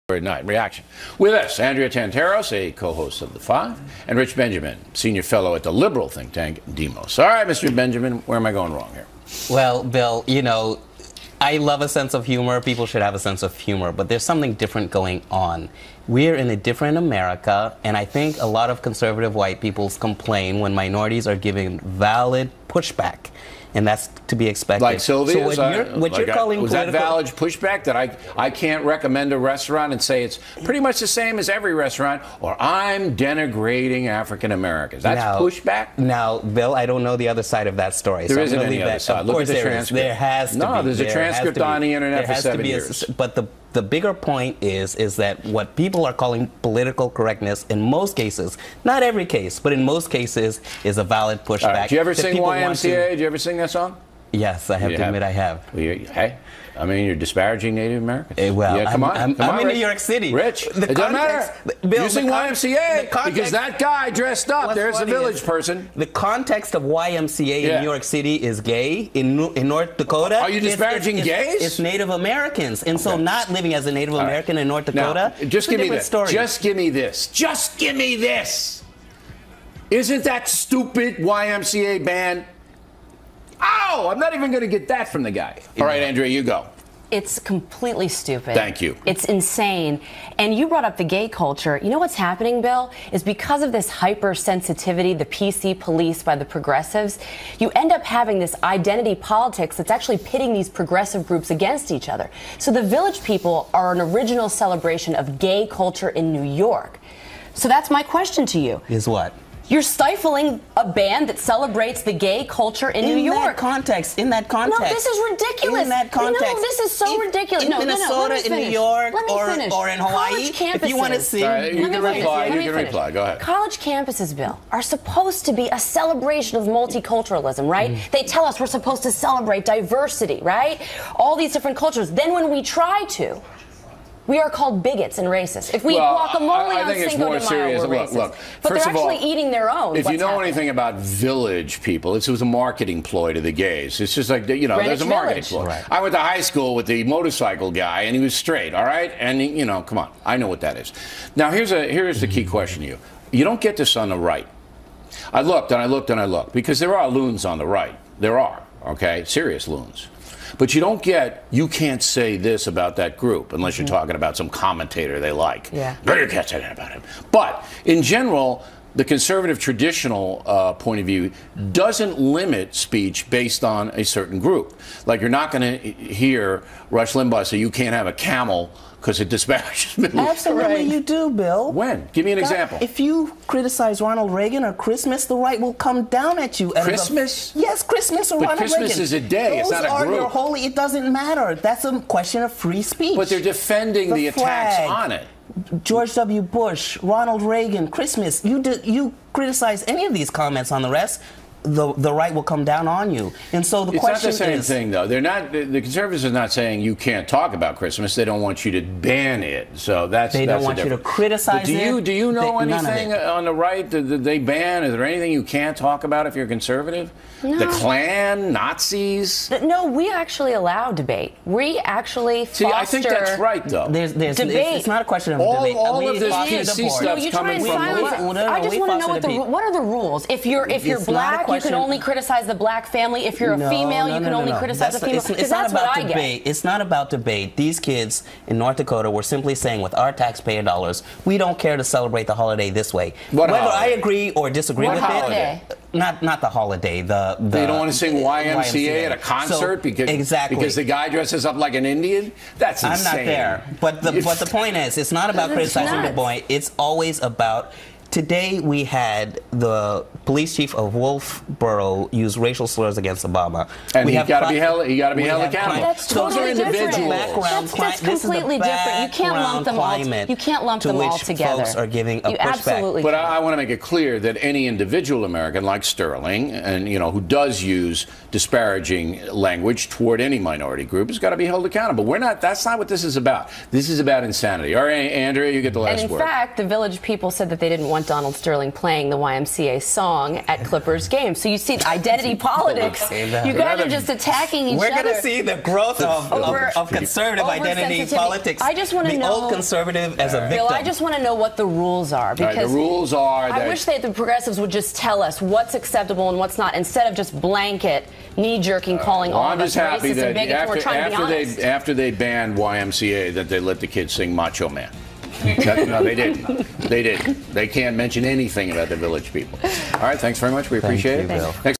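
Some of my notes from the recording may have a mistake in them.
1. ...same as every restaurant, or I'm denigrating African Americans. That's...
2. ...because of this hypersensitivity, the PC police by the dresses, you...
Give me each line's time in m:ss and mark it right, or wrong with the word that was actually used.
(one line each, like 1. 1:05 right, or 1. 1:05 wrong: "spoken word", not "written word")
1. 0:31 right
2. 1:33 wrong: "progressives", not "dresses".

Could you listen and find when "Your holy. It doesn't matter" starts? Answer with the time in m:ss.
3:10.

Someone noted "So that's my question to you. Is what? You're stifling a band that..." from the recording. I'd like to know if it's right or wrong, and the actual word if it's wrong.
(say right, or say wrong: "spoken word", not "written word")
right.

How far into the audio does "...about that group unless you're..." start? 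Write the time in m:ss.
2:42.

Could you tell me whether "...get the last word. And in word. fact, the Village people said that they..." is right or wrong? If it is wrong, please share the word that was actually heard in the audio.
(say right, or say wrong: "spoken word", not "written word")
right.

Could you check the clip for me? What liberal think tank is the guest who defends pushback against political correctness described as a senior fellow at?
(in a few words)
Demos.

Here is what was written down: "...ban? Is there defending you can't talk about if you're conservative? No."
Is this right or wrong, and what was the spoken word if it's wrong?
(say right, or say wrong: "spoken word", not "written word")
wrong: "anything", not "defending".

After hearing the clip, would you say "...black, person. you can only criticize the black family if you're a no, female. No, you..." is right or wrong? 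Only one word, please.
wrong.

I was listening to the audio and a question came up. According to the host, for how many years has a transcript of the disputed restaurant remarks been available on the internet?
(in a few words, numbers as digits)
7.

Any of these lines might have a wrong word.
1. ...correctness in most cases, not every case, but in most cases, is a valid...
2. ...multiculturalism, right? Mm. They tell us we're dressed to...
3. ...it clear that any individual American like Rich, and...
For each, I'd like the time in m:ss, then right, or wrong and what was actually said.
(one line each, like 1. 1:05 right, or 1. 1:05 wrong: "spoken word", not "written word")
1. 0:47 right
2. 2:06 wrong: "supposed", not "dressed"
3. 4:33 wrong: "Sterling", not "Rich".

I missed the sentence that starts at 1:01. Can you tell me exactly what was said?
Bill, Using the YMCA the context, because that guy dressed up, there's a village is, person.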